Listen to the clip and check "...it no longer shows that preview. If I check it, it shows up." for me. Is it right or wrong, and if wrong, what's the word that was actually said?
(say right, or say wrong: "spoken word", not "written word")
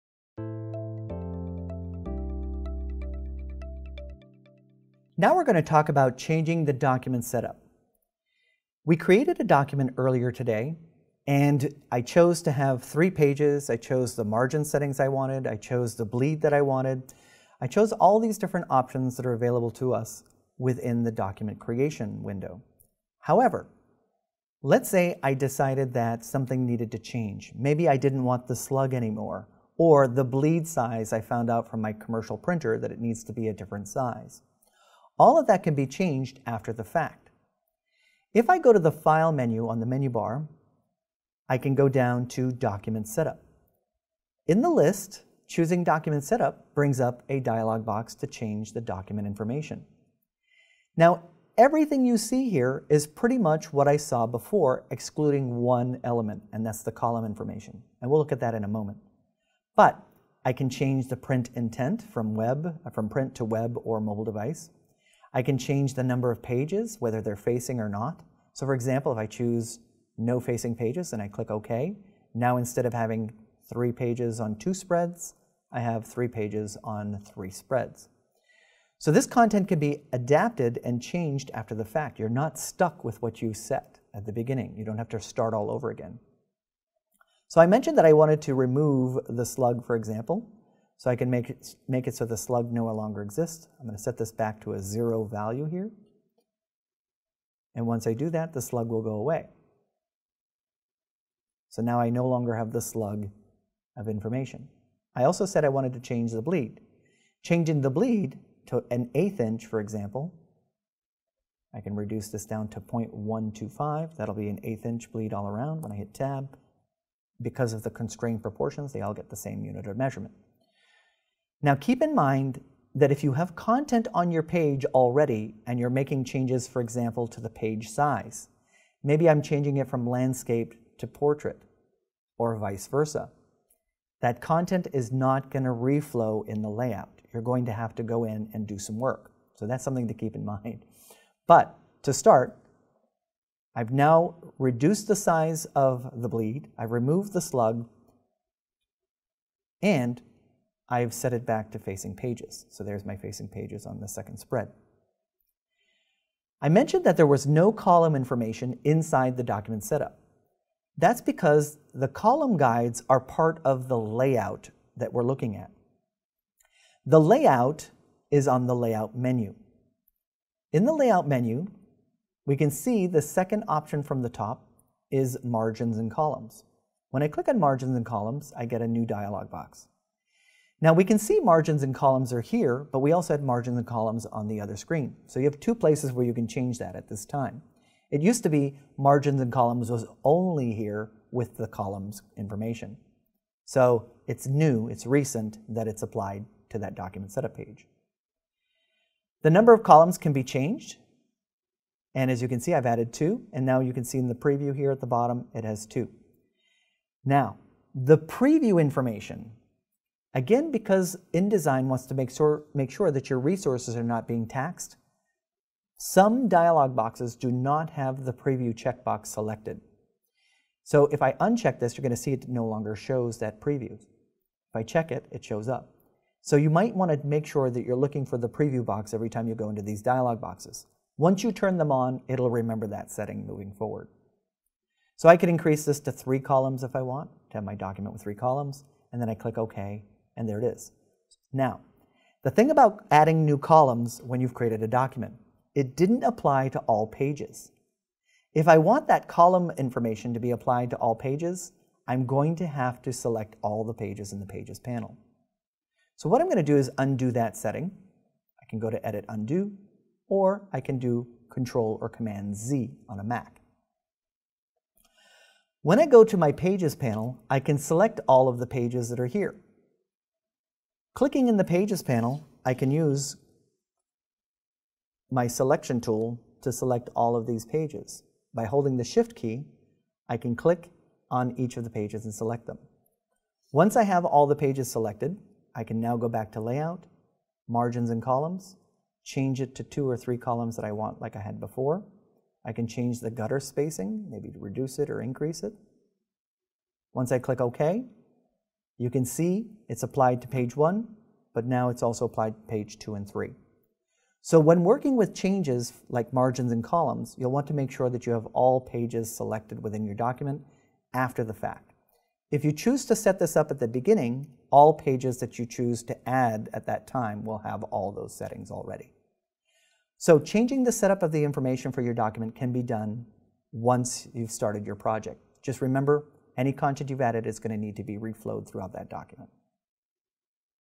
right.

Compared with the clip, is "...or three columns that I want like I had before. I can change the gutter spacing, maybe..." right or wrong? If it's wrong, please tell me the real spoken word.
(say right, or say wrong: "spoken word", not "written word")
right.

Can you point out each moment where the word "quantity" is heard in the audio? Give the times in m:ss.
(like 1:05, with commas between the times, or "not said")
not said.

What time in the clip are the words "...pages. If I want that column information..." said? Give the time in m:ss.
4:07.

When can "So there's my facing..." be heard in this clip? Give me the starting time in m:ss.
2:32.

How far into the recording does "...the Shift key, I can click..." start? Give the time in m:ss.
4:38.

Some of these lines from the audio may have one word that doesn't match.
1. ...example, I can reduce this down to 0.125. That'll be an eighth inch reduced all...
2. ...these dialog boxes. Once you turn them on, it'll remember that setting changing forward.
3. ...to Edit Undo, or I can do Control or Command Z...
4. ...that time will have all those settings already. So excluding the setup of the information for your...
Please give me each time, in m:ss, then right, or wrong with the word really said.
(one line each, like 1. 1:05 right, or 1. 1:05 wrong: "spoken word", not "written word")
1. 1:49 wrong: "bleed", not "reduced"
2. 3:49 wrong: "moving", not "changing"
3. 4:18 right
4. 5:16 wrong: "changing", not "excluding".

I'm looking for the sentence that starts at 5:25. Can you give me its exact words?
Just remember, any content you've added is going to need to be reflowed throughout that document.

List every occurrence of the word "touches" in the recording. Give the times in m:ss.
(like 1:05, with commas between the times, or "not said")
not said.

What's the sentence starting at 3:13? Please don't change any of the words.
So it's new, it's recent that it's applied to that document setup page.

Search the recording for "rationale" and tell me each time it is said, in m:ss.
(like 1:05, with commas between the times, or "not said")
not said.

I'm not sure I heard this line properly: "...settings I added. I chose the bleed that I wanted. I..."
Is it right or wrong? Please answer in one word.
wrong.